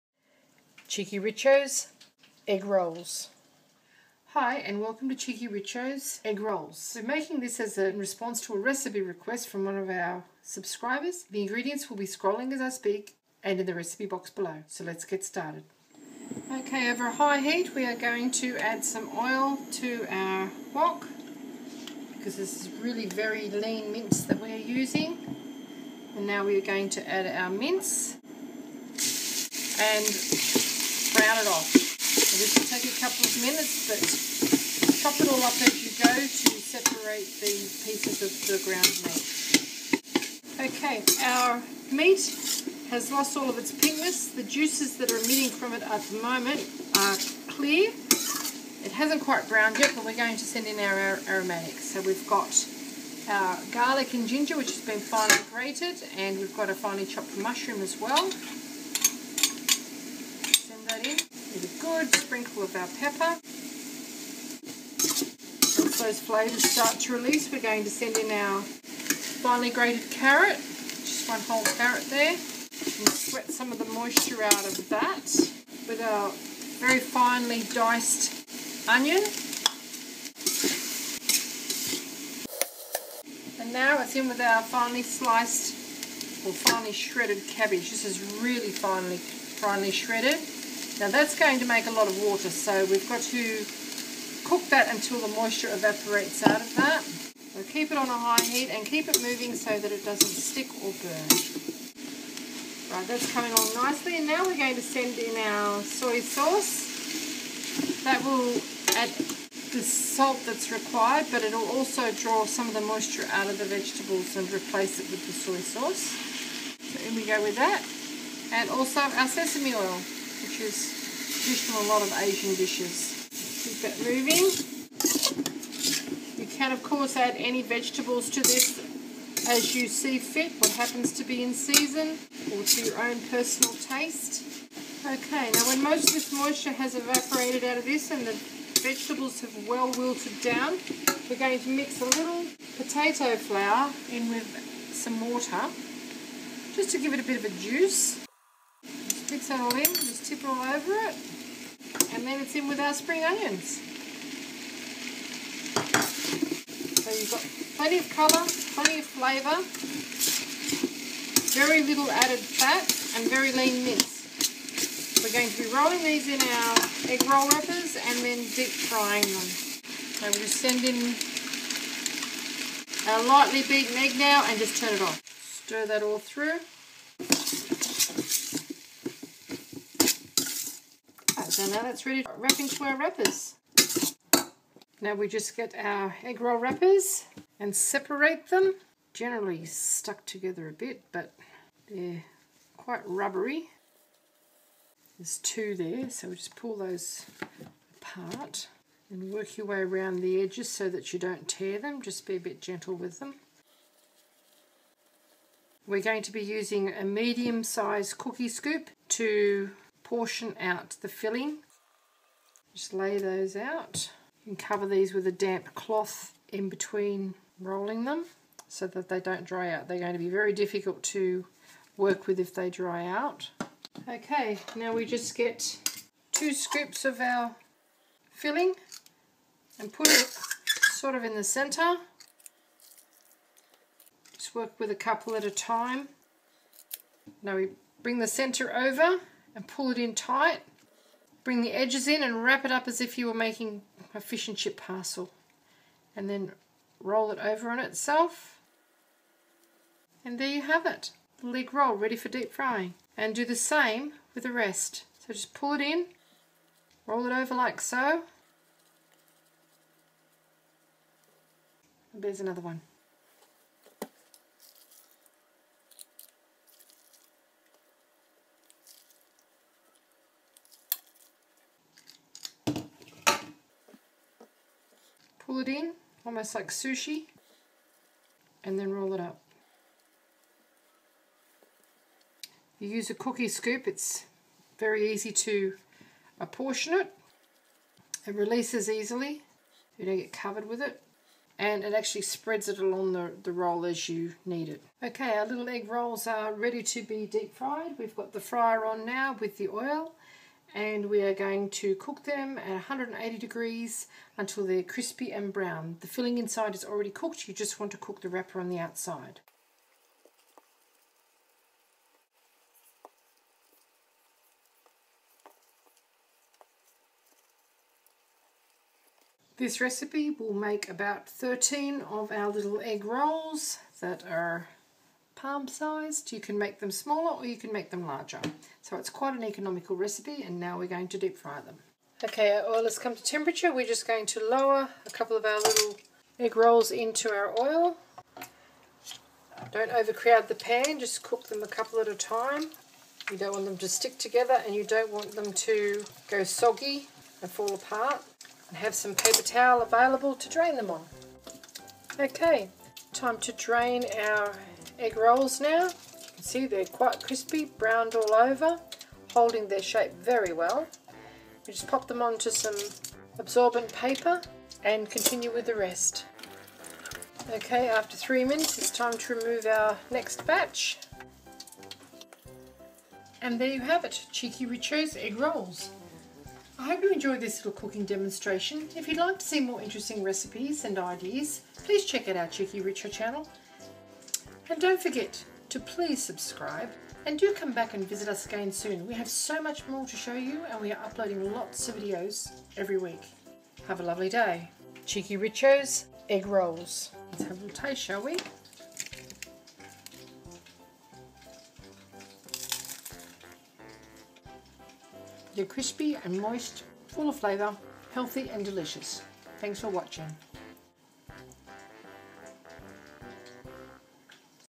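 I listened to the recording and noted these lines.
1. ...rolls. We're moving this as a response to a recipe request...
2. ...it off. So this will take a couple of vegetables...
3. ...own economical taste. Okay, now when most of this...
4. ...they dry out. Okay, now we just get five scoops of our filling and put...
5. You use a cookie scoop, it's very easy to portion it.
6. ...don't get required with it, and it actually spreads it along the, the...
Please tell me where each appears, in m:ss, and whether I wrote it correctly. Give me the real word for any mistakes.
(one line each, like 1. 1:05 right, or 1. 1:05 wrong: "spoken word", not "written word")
1. 0:06 wrong: "making", not "moving"
2. 0:31 wrong: "minutes", not "vegetables"
3. 2:13 wrong: "personal", not "economical"
4. 3:42 wrong: "two", not "five"
5. 4:42 wrong: "apportion", not "portion"
6. 4:50 wrong: "covered", not "required".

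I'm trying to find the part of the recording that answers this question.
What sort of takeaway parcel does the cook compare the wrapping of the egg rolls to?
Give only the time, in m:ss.
4:04.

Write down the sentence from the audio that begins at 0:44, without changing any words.
The juices that are emitting from it at the moment are clear.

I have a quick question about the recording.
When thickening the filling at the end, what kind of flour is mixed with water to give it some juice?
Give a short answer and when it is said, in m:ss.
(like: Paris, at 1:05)
potato flour, at 2:22.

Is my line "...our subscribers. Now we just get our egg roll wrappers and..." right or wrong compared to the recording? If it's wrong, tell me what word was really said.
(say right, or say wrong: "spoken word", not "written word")
wrong: "wrappers", not "subscribers".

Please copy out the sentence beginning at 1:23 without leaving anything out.
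And now it's in with our finely sliced or finely shredded cabbage.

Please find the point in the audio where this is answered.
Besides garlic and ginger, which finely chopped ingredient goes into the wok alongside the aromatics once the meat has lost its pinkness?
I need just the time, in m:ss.
0:57.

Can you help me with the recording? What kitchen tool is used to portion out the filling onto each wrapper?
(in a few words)
medium-sized cookie scoop.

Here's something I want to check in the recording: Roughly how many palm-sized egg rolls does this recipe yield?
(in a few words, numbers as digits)
13.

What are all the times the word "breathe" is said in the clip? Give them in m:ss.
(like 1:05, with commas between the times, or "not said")
not said.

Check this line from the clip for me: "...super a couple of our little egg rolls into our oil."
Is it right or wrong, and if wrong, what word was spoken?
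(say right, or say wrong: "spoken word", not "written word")
wrong: "lower", not "super".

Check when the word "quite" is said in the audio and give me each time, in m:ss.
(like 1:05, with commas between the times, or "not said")
0:49, 3:12, 5:29, 5:56.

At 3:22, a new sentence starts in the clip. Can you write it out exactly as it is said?
Just be a bit gentle with them.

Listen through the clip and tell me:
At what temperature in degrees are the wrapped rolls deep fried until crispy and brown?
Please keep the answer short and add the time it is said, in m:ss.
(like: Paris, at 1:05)
180, at 5:02.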